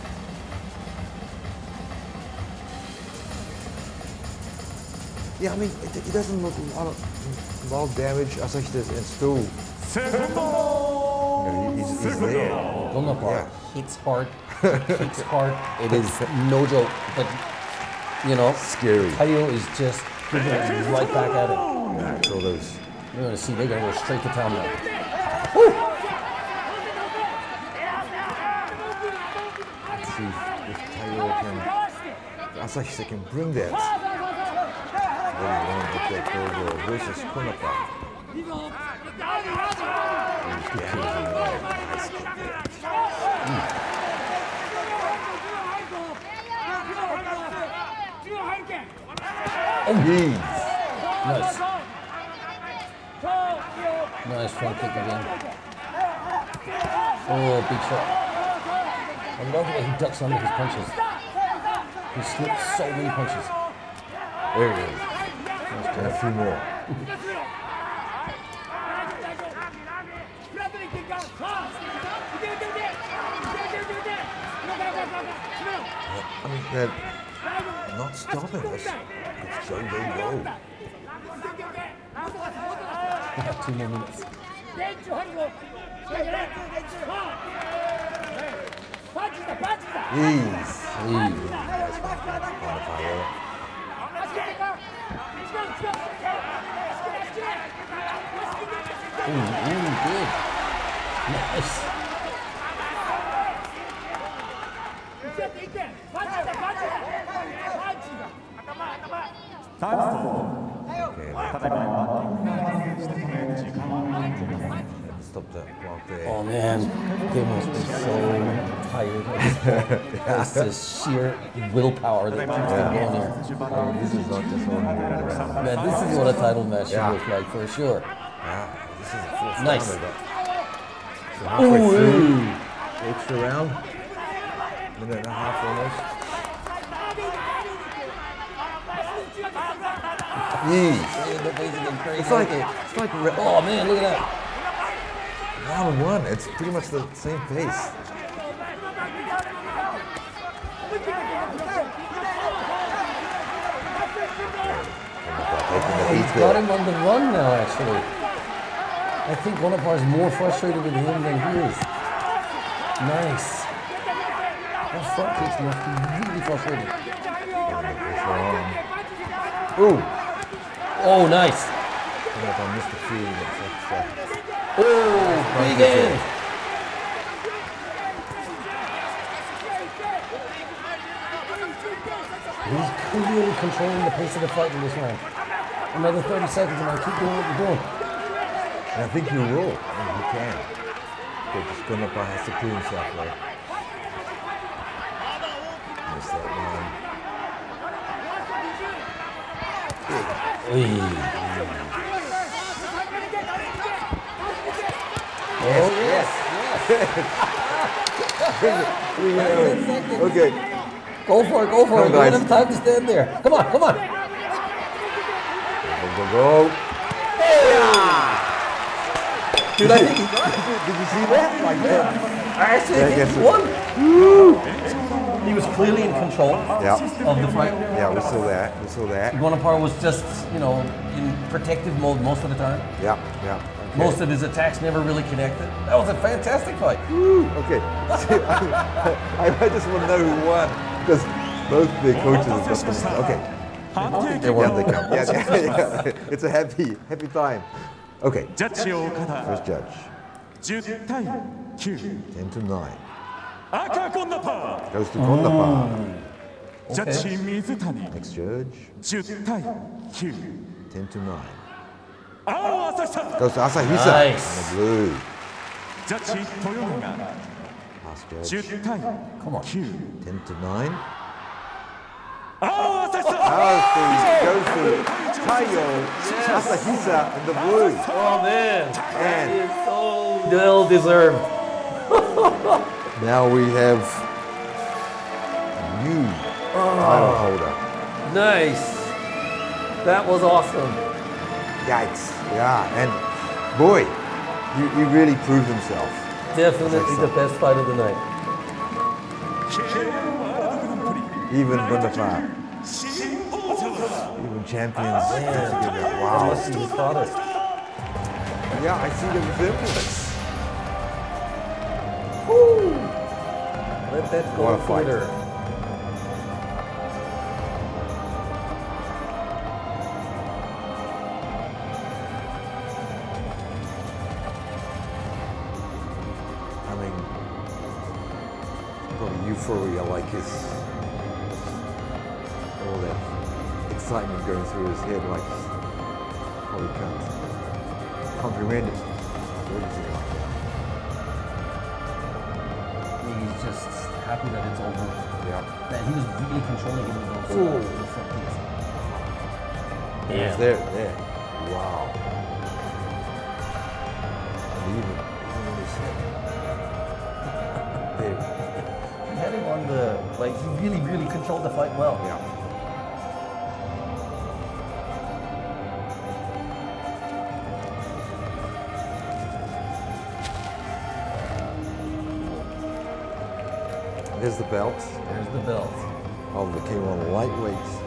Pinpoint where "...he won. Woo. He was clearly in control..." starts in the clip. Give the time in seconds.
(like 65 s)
223 s.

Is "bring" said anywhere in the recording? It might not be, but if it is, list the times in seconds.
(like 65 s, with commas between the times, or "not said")
33 s.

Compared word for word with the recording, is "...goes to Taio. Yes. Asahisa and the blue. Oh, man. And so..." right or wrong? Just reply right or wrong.
right.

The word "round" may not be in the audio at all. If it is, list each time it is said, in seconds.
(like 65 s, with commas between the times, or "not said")
133 s, 145 s, 184 s.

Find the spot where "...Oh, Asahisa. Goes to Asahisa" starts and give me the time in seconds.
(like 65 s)
262 s.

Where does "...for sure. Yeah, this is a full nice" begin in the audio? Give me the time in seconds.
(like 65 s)
127 s.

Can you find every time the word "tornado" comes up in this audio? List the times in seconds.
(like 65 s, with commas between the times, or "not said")
not said.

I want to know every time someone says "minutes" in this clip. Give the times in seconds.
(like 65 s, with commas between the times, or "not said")
86 s, 134 s.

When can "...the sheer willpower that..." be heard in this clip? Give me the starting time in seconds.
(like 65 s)
120 s.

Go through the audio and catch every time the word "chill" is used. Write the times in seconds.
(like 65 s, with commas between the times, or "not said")
not said.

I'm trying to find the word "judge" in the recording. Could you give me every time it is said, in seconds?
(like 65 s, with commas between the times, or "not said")
249 s, 258 s, 268 s.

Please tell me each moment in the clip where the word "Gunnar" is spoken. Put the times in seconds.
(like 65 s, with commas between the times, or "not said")
12 s.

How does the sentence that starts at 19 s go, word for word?
Taio is just giving it right back at it.